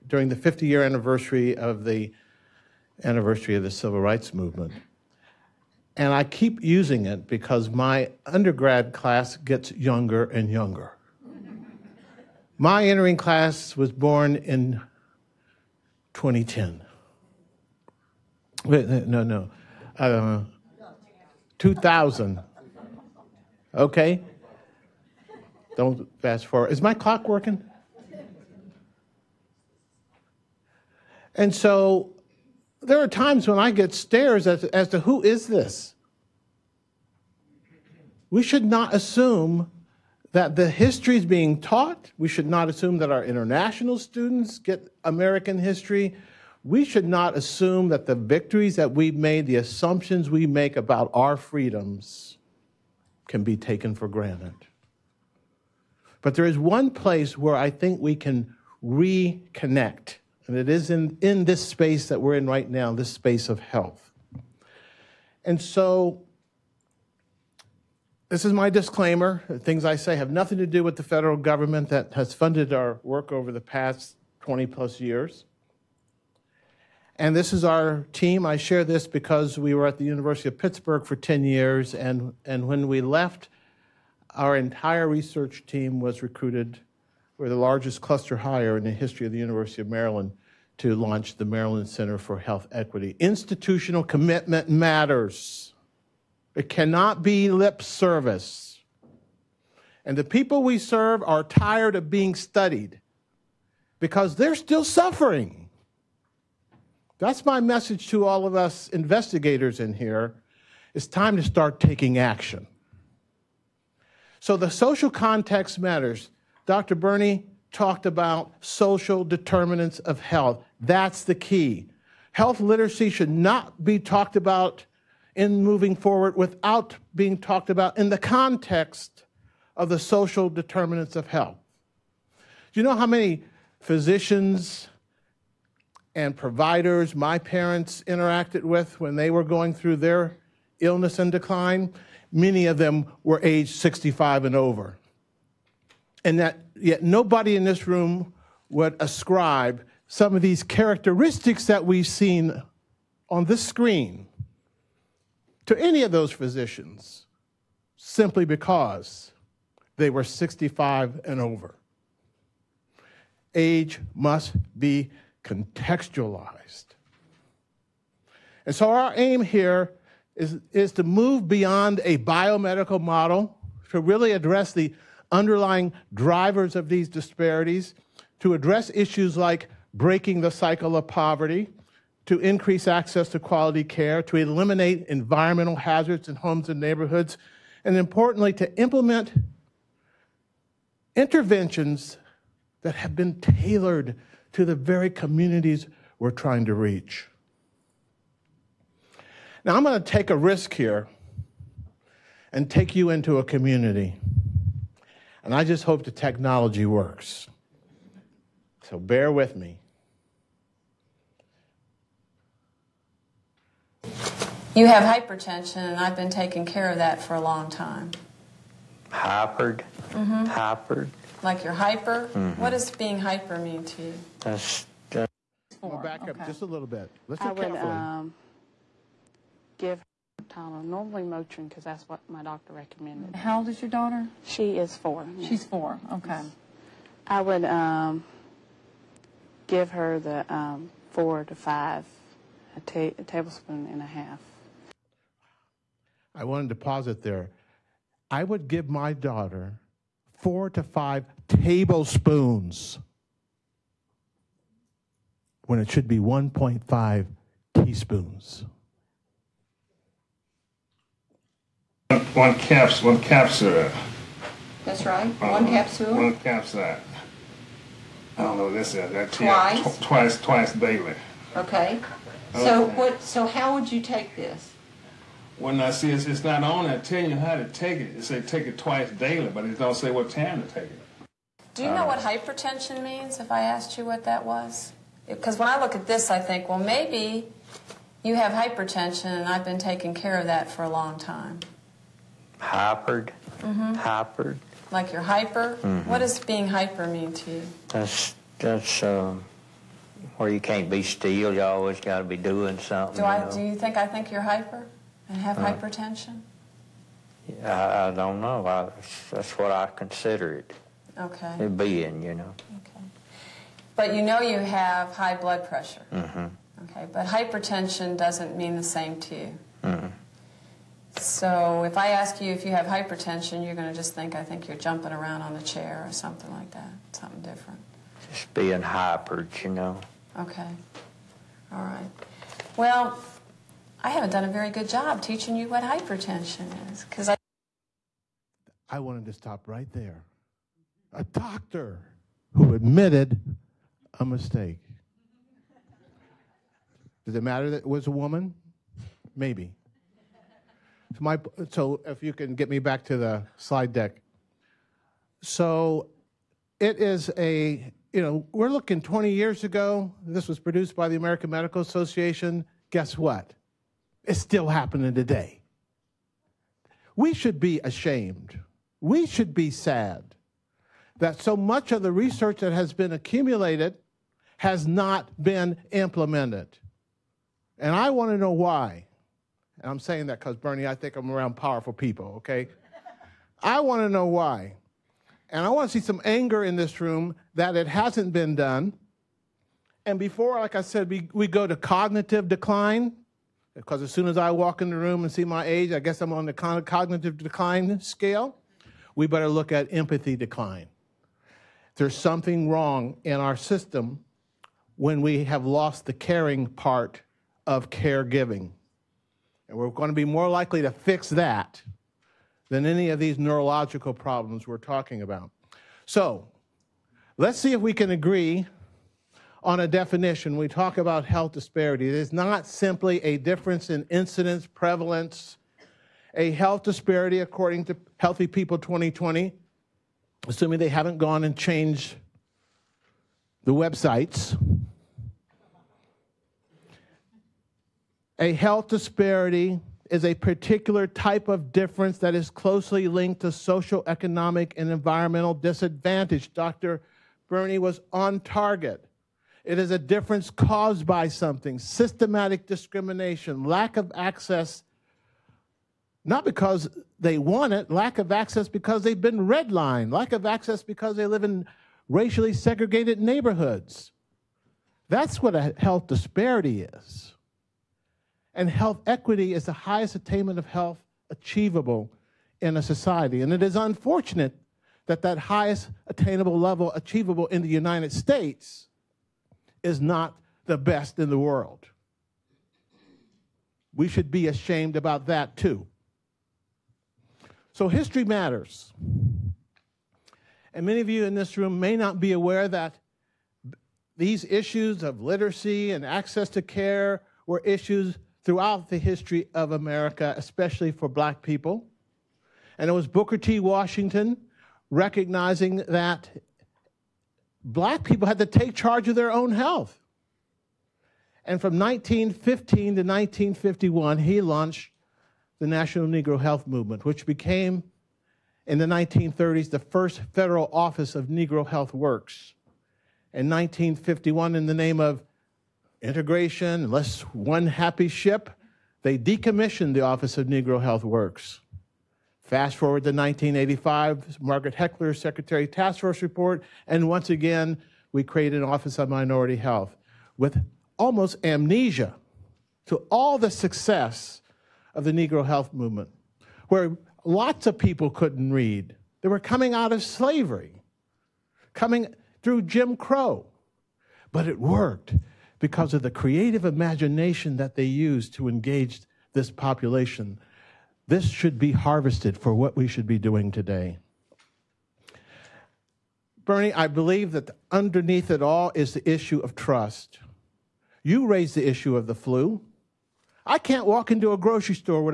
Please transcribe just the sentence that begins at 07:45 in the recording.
That's what a health disparity is.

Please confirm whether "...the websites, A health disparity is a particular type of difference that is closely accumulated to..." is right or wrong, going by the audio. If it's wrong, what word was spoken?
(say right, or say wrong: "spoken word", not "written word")
wrong: "linked", not "accumulated".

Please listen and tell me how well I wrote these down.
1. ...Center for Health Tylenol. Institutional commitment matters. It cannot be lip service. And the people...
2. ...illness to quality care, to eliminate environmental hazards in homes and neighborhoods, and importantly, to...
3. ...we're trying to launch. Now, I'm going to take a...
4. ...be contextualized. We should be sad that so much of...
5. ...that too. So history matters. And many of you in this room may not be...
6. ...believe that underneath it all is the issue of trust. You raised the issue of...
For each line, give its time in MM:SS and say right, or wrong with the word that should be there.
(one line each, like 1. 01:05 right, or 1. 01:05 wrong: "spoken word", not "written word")
1. 01:31 wrong: "Equity", not "Tylenol"
2. 03:02 wrong: "access", not "illness"
3. 03:16 wrong: "reach", not "launch"
4. 06:07 wrong: "ashamed", not "contextualized"
5. 08:05 right
6. 09:26 right.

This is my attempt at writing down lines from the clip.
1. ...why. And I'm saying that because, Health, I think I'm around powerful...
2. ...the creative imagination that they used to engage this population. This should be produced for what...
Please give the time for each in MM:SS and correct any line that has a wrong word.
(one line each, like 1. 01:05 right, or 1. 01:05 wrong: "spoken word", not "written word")
1. 06:18 wrong: "Bernie", not "Health"
2. 09:16 wrong: "harvested", not "produced".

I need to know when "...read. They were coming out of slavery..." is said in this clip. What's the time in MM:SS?
09:08.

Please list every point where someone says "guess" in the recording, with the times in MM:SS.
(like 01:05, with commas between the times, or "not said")
06:02, 06:35.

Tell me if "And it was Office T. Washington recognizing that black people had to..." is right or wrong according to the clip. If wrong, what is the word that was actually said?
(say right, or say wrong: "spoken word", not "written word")
wrong: "Booker", not "Office".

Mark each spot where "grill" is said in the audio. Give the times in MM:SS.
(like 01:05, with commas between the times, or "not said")
not said.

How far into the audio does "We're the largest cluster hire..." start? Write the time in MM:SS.
01:27.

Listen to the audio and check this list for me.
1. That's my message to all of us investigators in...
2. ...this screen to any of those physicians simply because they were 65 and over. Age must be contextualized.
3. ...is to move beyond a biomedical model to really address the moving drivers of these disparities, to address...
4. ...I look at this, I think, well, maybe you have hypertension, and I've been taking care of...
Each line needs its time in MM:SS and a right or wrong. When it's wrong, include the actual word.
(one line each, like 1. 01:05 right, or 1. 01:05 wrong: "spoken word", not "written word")
1. 01:47 right
2. 02:33 right
3. 02:50 wrong: "underlying", not "moving"
4. 04:45 right.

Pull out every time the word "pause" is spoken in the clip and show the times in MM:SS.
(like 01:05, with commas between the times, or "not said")
04:06.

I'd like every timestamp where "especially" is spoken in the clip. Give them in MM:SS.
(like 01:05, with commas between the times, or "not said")
08:20.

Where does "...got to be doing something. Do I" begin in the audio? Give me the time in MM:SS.
05:01.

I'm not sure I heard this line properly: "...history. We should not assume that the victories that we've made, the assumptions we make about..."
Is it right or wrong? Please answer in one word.
right.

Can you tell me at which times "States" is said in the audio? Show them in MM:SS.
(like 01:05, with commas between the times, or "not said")
07:58.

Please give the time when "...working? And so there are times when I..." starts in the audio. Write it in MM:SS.
00:27.